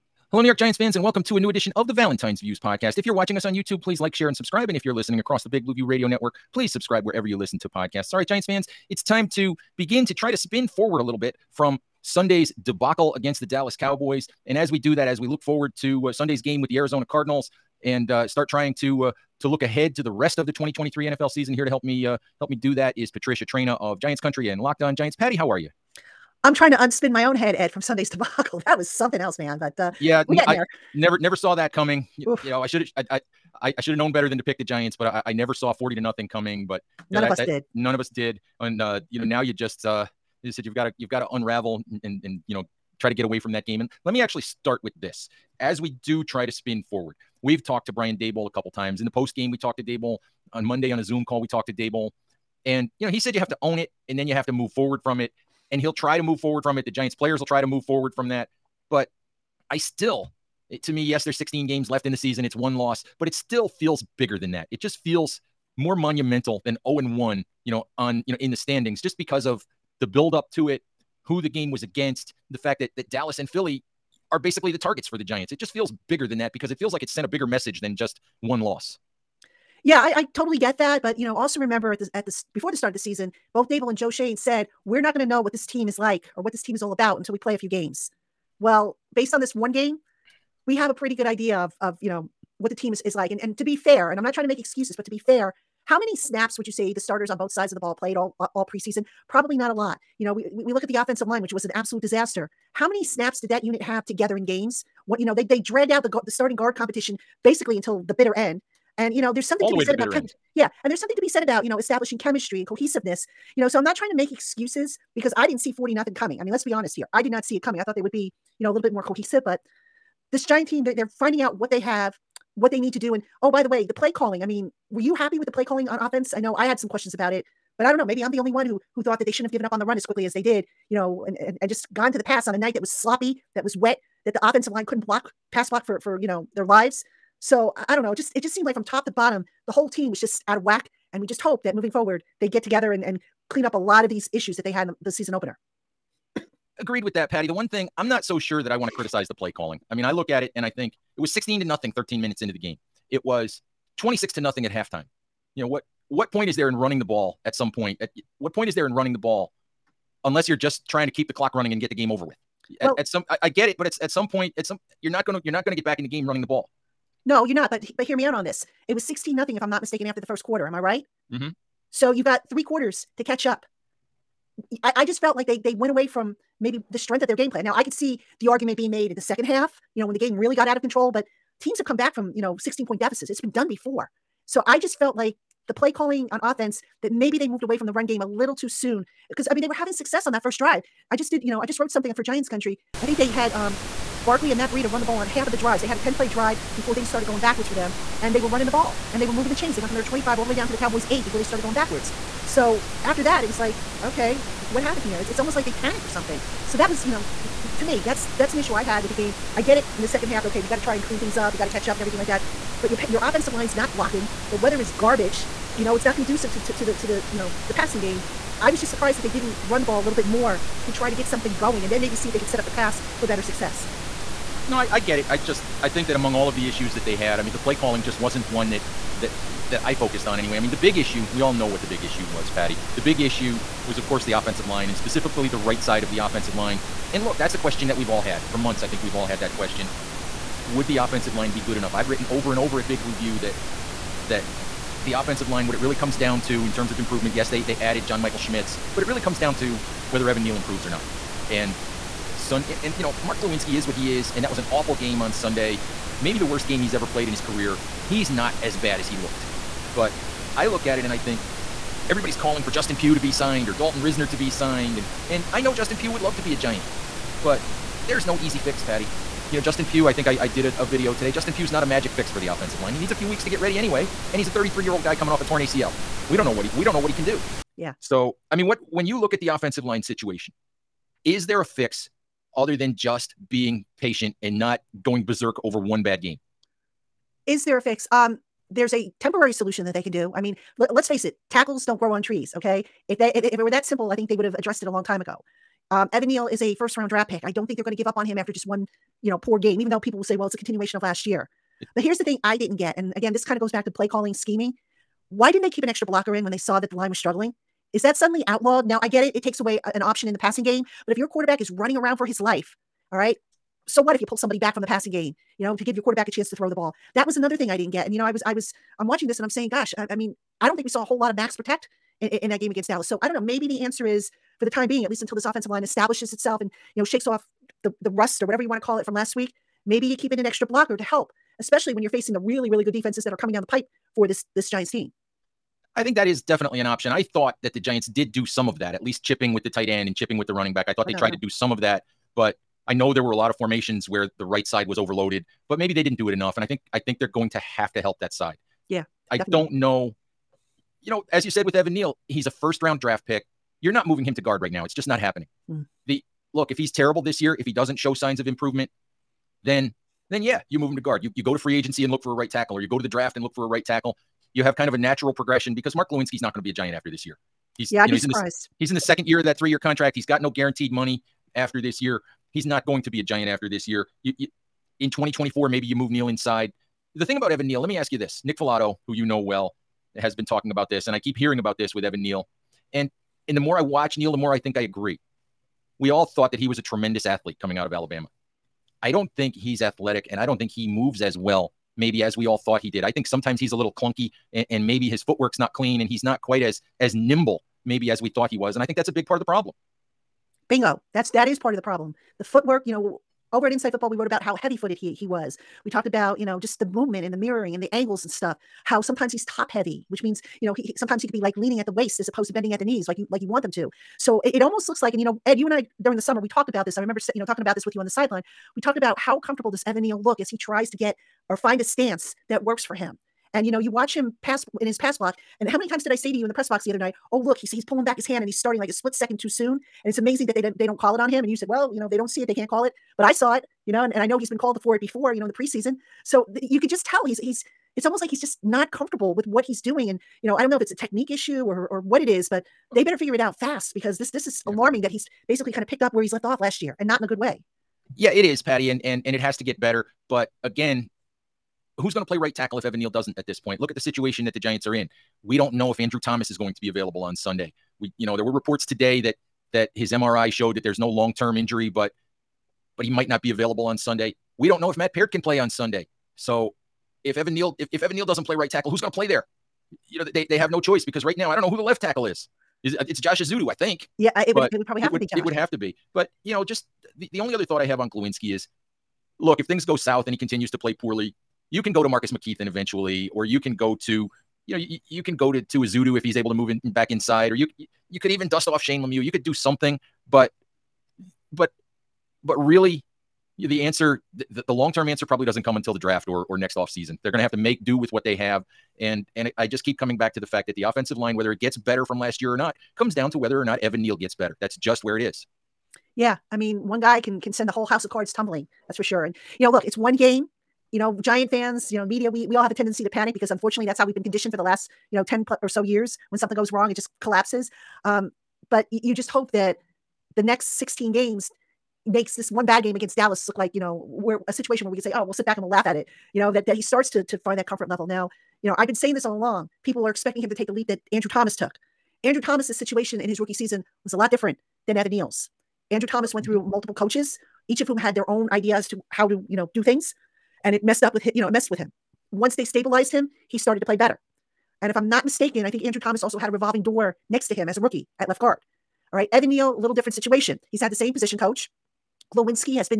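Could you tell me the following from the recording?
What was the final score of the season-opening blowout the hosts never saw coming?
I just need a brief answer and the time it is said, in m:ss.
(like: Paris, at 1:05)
40 to nothing, at 0:35.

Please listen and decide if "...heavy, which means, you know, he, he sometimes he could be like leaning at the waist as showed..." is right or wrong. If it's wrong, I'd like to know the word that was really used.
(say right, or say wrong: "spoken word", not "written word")
wrong: "opposed", not "showed".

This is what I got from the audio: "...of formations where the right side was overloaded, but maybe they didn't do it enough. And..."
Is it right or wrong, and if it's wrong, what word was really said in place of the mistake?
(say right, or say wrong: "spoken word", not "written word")
right.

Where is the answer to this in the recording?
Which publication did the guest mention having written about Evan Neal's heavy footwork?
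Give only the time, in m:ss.
6:43.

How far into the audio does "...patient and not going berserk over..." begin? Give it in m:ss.
4:44.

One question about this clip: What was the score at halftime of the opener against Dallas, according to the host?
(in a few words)
26 to nothing.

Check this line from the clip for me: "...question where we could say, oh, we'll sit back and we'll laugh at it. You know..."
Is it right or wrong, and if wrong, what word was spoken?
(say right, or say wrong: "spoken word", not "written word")
wrong: "situation", not "question".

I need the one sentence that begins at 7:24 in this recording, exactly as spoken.
alarming that he's basically kind of picked up where he's left off last year and not in a good way.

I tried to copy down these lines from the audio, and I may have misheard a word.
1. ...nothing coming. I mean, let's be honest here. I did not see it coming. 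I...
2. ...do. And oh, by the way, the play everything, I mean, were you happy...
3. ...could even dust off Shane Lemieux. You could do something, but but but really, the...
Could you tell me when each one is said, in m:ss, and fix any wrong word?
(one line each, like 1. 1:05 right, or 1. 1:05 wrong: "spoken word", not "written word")
1. 1:55 right
2. 2:02 wrong: "calling", not "everything"
3. 8:08 right.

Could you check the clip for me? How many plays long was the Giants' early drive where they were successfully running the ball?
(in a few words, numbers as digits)
10.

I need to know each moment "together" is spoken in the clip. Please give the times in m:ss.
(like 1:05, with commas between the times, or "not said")
1:44, 2:22.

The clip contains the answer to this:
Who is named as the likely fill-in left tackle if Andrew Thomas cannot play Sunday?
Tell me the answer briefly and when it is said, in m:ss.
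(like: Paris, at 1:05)
Josh Ezeudu, at 7:53.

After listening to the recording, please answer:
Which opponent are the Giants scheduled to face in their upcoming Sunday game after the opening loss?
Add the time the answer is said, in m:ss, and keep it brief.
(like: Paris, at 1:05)
Arizona Cardinals, at 0:16.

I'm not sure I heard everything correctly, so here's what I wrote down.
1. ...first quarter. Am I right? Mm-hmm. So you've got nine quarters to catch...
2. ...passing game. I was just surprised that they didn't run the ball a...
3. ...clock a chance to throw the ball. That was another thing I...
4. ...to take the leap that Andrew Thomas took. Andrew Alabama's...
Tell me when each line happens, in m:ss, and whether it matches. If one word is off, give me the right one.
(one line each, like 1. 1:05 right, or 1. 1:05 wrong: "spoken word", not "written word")
1. 2:50 wrong: "three", not "nine"
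2. 3:37 right
3. 5:16 wrong: "quarterback", not "clock"
4. 8:50 wrong: "Thomas", not "Alabama".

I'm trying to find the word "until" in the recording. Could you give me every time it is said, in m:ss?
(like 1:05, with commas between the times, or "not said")
1:27, 1:47, 5:25, 8:15.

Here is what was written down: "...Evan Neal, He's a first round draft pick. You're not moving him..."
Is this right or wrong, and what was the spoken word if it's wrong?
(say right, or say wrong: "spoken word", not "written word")
right.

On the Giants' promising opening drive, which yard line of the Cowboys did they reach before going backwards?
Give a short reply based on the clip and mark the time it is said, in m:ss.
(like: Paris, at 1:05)
8, at 3:21.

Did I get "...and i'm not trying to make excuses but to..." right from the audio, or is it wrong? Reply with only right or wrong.
right.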